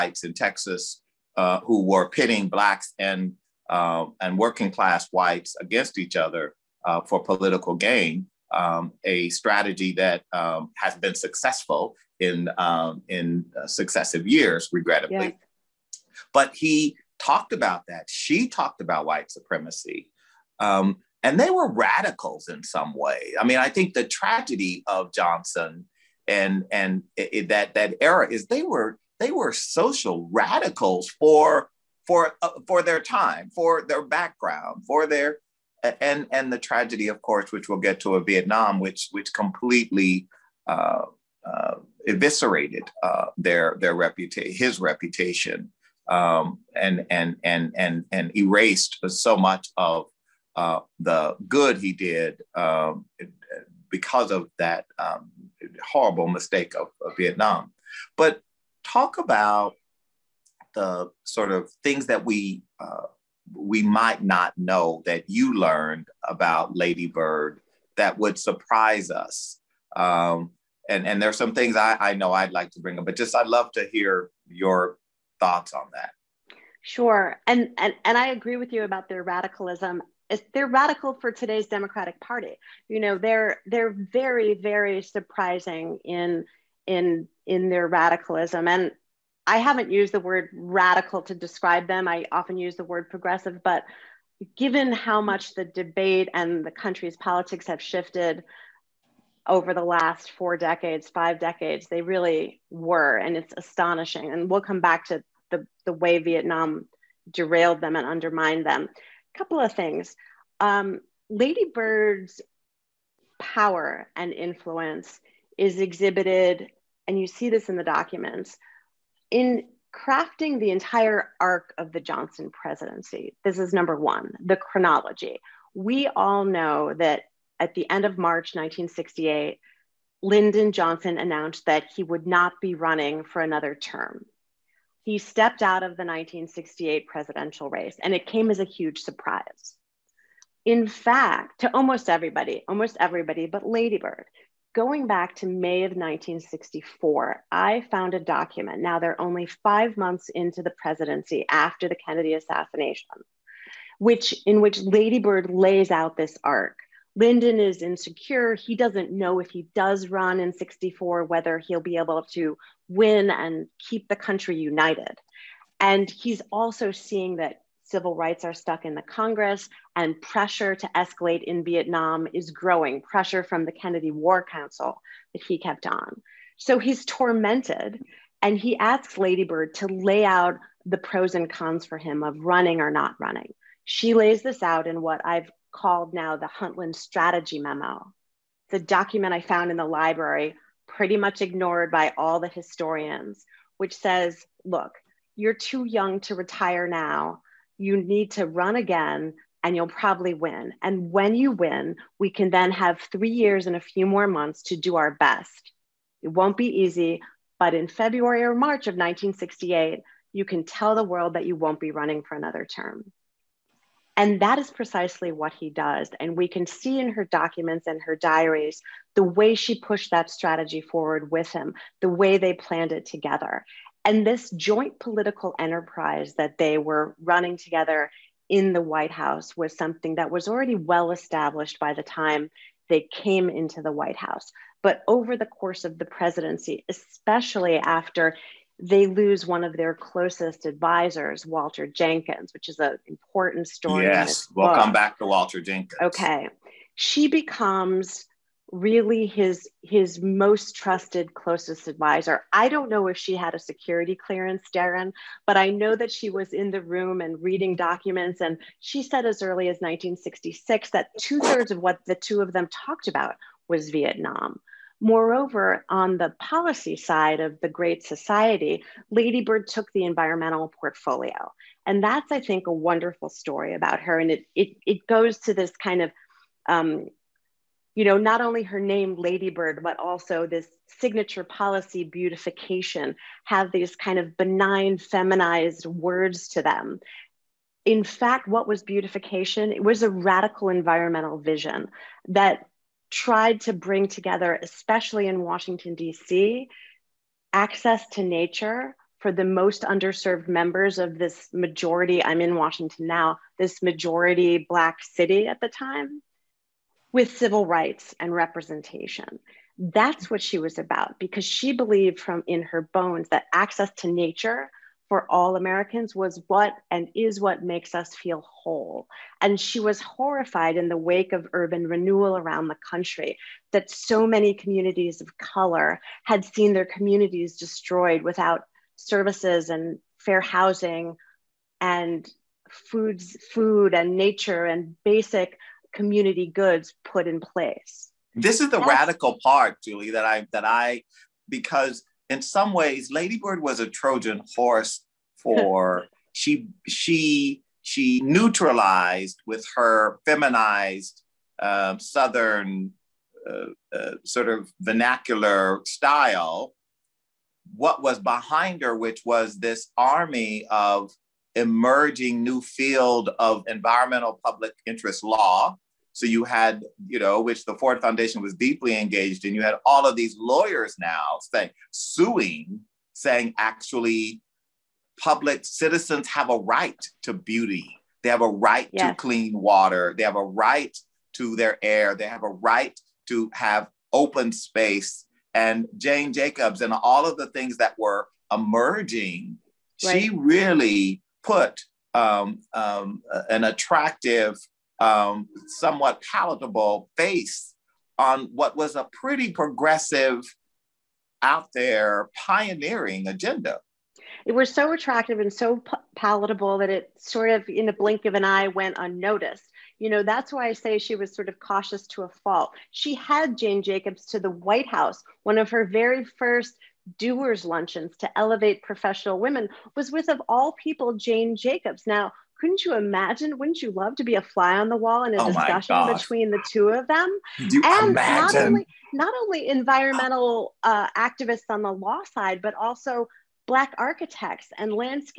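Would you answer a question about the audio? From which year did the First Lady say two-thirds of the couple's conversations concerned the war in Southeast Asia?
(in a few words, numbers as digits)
1966.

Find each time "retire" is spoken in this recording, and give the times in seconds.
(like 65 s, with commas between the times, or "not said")
196 s.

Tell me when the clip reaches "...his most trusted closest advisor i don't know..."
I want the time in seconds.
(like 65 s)
249 s.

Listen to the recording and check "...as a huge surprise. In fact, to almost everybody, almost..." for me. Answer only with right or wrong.
right.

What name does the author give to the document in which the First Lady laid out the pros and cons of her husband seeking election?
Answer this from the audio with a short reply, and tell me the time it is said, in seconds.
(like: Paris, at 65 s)
Huntland Strategy Memo, at 186 s.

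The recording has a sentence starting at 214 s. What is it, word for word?
And that is precisely what he does.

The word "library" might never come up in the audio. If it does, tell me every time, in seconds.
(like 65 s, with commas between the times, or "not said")
189 s.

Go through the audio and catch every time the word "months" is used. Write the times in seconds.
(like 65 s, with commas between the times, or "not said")
149 s, 204 s.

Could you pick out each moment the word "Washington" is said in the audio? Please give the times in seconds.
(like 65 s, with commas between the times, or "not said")
295 s, 302 s.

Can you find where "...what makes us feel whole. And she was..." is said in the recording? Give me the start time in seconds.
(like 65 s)
317 s.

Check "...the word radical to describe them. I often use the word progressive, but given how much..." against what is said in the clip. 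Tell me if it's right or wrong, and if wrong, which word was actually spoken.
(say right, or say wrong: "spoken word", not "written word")
right.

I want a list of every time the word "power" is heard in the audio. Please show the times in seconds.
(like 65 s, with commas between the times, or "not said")
113 s.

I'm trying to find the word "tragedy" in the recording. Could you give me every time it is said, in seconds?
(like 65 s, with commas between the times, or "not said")
24 s, 36 s.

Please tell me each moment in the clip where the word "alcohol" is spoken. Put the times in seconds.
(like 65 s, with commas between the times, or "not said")
not said.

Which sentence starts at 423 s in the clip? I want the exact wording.
Wouldn't you love to be a fly on the wall in a oh discussion between the two of them?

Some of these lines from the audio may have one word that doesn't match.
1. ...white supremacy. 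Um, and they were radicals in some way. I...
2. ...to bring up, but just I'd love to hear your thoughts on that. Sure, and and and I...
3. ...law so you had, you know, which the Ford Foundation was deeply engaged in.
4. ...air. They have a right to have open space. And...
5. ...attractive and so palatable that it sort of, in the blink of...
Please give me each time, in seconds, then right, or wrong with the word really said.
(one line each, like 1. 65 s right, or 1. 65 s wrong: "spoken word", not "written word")
1. 19 s right
2. 72 s right
3. 365 s right
4. 381 s right
5. 404 s right.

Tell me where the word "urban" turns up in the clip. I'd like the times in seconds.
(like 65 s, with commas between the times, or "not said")
321 s.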